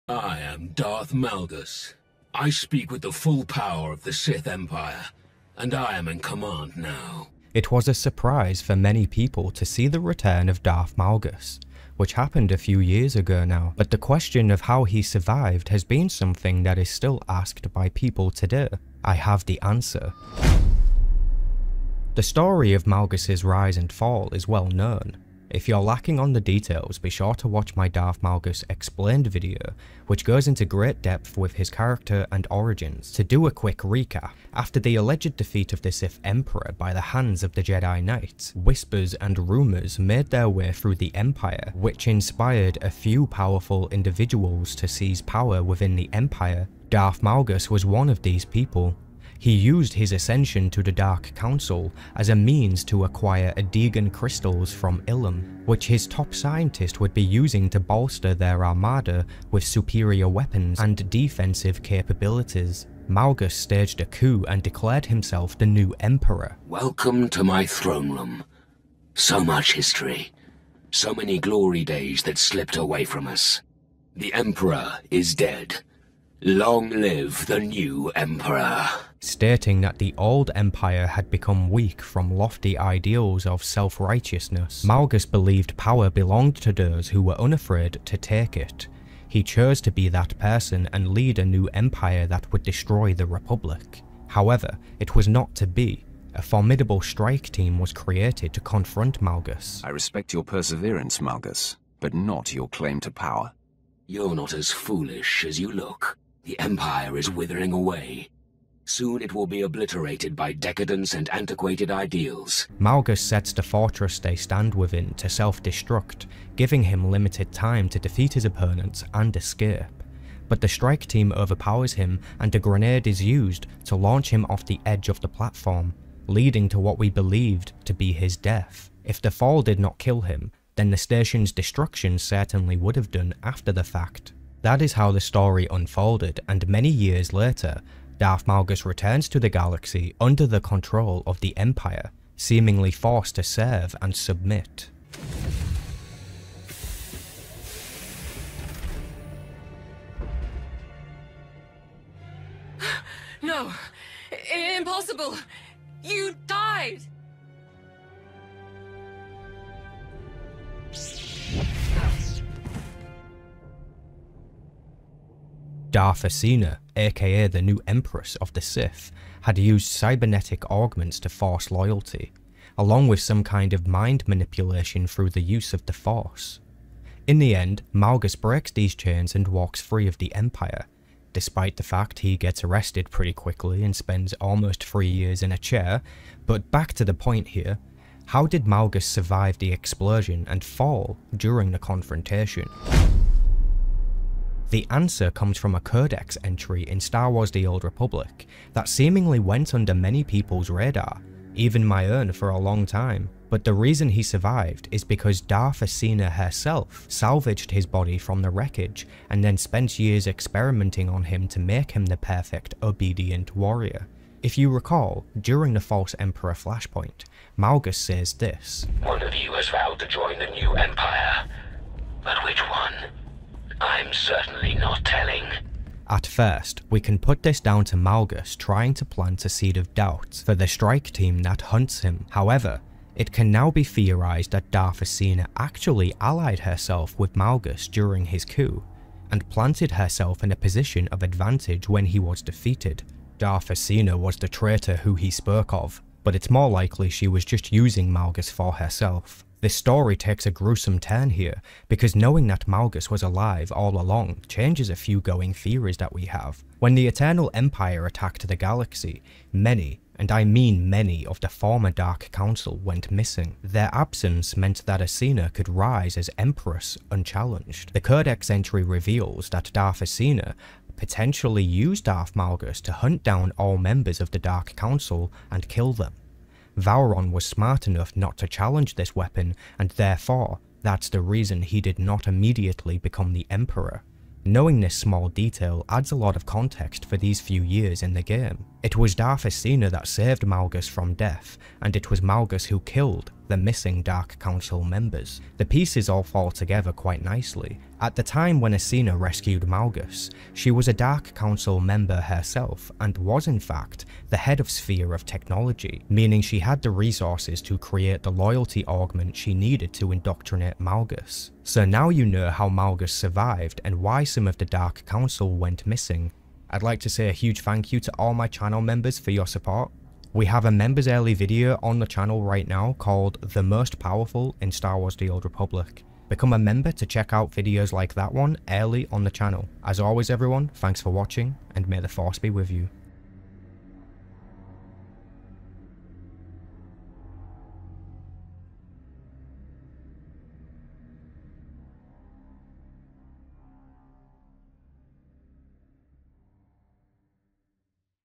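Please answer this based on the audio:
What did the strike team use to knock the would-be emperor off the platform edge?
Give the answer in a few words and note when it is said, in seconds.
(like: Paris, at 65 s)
A grenade, at 122 s.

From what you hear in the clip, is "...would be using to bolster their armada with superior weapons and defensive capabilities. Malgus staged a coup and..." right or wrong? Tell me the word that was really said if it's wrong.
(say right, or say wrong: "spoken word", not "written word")
right.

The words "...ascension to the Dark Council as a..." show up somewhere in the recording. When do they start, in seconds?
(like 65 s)
50 s.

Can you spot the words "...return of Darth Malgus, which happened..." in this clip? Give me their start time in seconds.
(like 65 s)
10 s.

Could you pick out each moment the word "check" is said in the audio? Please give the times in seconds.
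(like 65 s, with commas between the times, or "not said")
327 s.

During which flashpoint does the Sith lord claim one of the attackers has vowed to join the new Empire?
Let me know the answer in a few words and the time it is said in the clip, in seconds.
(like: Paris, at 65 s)
False Emperor, at 215 s.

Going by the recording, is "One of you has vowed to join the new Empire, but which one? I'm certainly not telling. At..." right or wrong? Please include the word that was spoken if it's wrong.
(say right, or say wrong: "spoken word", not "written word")
right.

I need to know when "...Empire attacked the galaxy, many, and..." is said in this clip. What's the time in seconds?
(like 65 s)
257 s.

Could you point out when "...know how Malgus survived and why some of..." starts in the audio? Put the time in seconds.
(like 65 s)
312 s.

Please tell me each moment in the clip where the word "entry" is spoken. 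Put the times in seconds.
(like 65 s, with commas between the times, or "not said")
196 s, 268 s.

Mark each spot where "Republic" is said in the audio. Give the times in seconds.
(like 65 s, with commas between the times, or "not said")
93 s, 197 s, 325 s.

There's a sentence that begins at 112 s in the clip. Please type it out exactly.
Malgus sets the fortress they stand within to self-destruct, giving him limited time to defeat his opponents and escape.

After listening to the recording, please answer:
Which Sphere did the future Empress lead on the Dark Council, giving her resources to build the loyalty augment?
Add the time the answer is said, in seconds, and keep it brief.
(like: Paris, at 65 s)
Sphere of Technology, at 304 s.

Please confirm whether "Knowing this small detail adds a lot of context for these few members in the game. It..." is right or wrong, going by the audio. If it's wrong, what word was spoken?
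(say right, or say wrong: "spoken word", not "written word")
wrong: "years", not "members".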